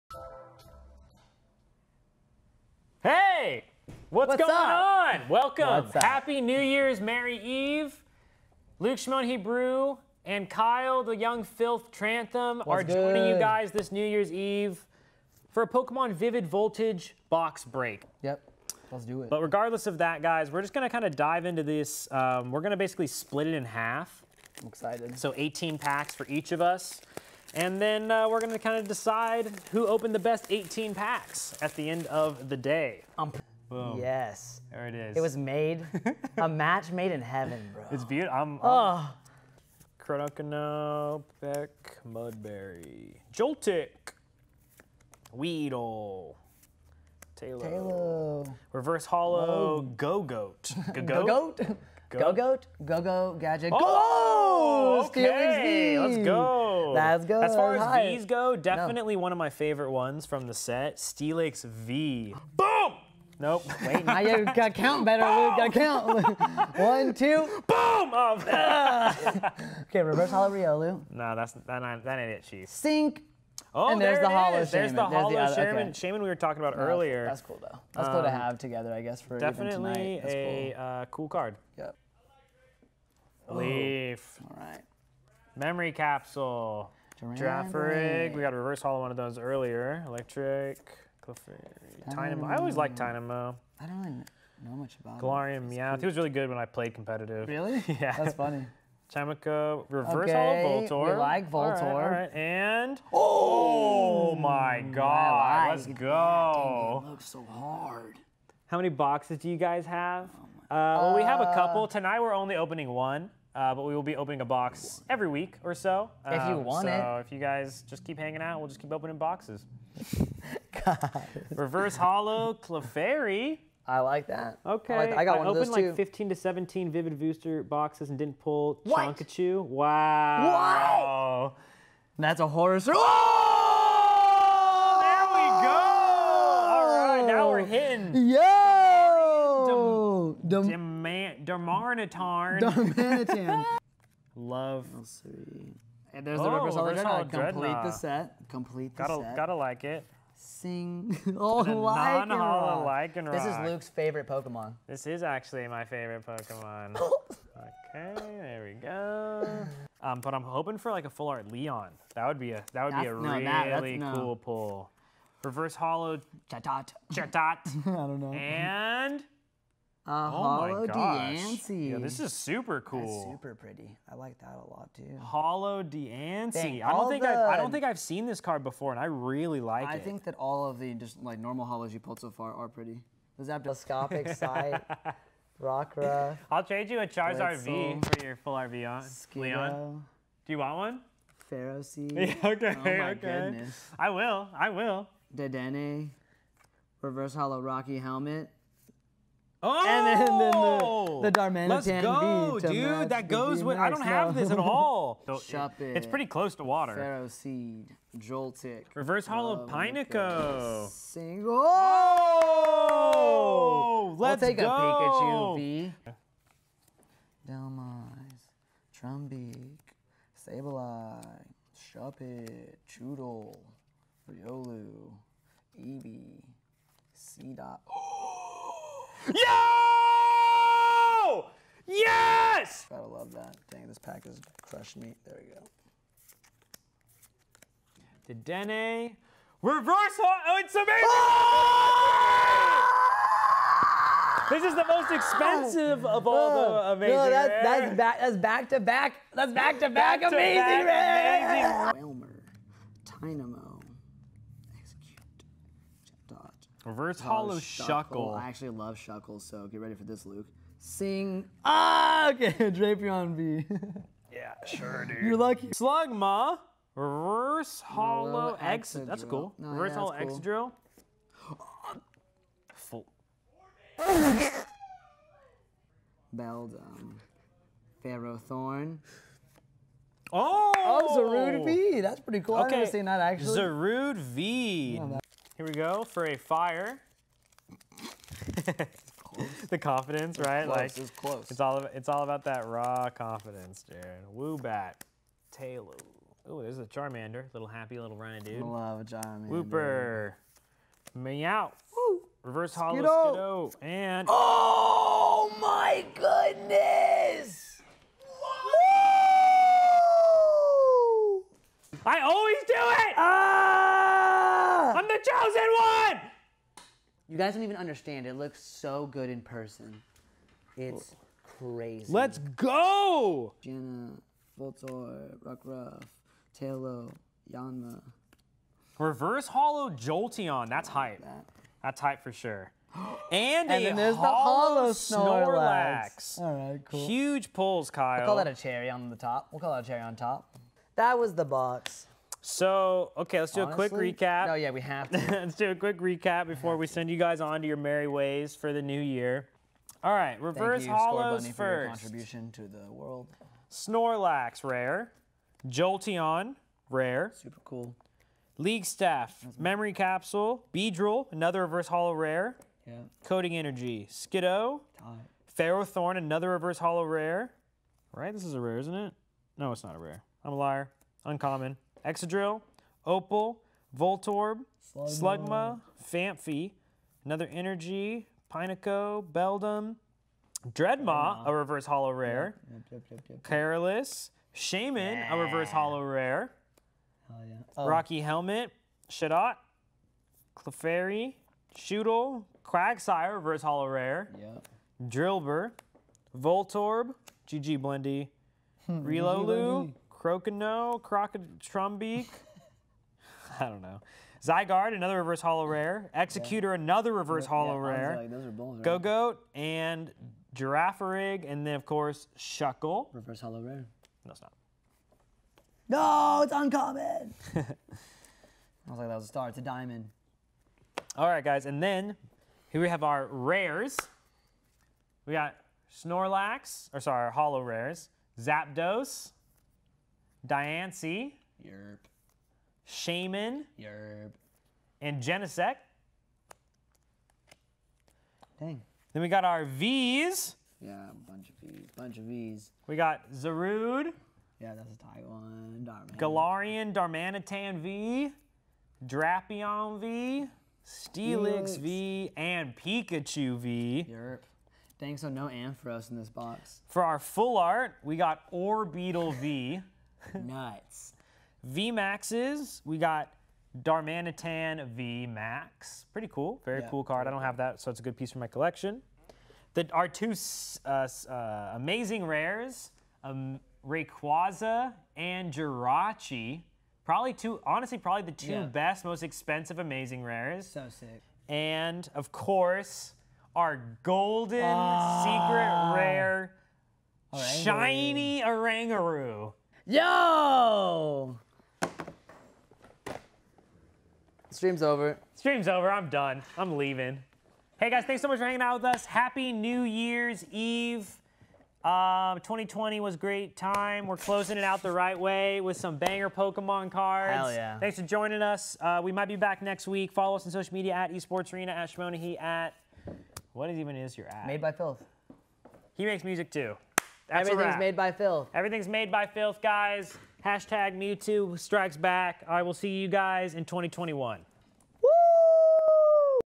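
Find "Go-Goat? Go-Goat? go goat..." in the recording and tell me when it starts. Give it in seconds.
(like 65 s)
51 s.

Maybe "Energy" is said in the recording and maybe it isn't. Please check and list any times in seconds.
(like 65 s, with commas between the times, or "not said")
363 s, 377 s.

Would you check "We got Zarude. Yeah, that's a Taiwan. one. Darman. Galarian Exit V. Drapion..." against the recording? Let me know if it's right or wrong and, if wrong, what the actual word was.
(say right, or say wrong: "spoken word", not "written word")
wrong: "Darmanitan", not "Exit".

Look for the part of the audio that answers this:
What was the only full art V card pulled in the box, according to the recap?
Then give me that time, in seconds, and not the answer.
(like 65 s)
458 s.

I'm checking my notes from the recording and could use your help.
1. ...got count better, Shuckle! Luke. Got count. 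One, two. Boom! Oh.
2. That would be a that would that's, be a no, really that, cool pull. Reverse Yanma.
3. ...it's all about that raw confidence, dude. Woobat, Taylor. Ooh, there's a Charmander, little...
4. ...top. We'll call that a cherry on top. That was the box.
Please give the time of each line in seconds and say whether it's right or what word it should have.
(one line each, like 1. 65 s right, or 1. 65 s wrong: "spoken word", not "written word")
1. 64 s wrong: "Boom", not "Shuckle"
2. 162 s wrong: "Holo", not "Yanma"
3. 291 s right
4. 339 s right.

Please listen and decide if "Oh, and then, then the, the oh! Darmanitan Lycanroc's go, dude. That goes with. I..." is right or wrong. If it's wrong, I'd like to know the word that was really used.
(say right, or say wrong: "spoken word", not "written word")
wrong: "Let", not "Lycanroc".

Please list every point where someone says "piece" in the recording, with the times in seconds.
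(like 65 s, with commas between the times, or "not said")
468 s.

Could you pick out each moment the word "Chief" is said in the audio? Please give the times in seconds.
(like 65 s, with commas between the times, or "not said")
72 s.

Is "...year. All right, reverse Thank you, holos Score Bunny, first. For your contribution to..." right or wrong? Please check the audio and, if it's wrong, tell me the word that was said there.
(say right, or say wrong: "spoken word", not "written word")
right.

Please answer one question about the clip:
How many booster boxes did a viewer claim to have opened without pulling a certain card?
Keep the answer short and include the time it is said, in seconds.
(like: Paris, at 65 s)
15 to 17, at 125 s.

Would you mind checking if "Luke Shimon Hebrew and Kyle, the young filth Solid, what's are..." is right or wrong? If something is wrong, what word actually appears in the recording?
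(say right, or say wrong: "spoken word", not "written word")
wrong: "Trantham", not "Solid".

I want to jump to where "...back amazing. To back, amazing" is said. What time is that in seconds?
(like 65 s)
250 s.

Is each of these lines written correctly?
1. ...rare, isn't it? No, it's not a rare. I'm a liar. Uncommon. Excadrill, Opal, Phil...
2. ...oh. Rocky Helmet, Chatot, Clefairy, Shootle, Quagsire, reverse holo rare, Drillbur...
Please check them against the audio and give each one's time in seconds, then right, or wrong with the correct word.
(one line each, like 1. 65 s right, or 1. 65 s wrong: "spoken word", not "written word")
1. 368 s wrong: "Voltorb", not "Phil"
2. 387 s right.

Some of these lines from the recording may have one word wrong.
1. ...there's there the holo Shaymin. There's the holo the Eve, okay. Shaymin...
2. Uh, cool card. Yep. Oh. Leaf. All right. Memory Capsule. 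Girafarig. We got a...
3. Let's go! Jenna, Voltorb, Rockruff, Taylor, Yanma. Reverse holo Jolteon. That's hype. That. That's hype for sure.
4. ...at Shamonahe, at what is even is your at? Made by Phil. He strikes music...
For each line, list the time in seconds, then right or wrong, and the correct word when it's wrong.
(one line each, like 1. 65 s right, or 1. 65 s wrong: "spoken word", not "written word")
1. 74 s wrong: "Shaymin", not "Eve"
2. 80 s right
3. 322 s right
4. 511 s wrong: "makes", not "strikes".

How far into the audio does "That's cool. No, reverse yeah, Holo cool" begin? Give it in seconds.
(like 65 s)
269 s.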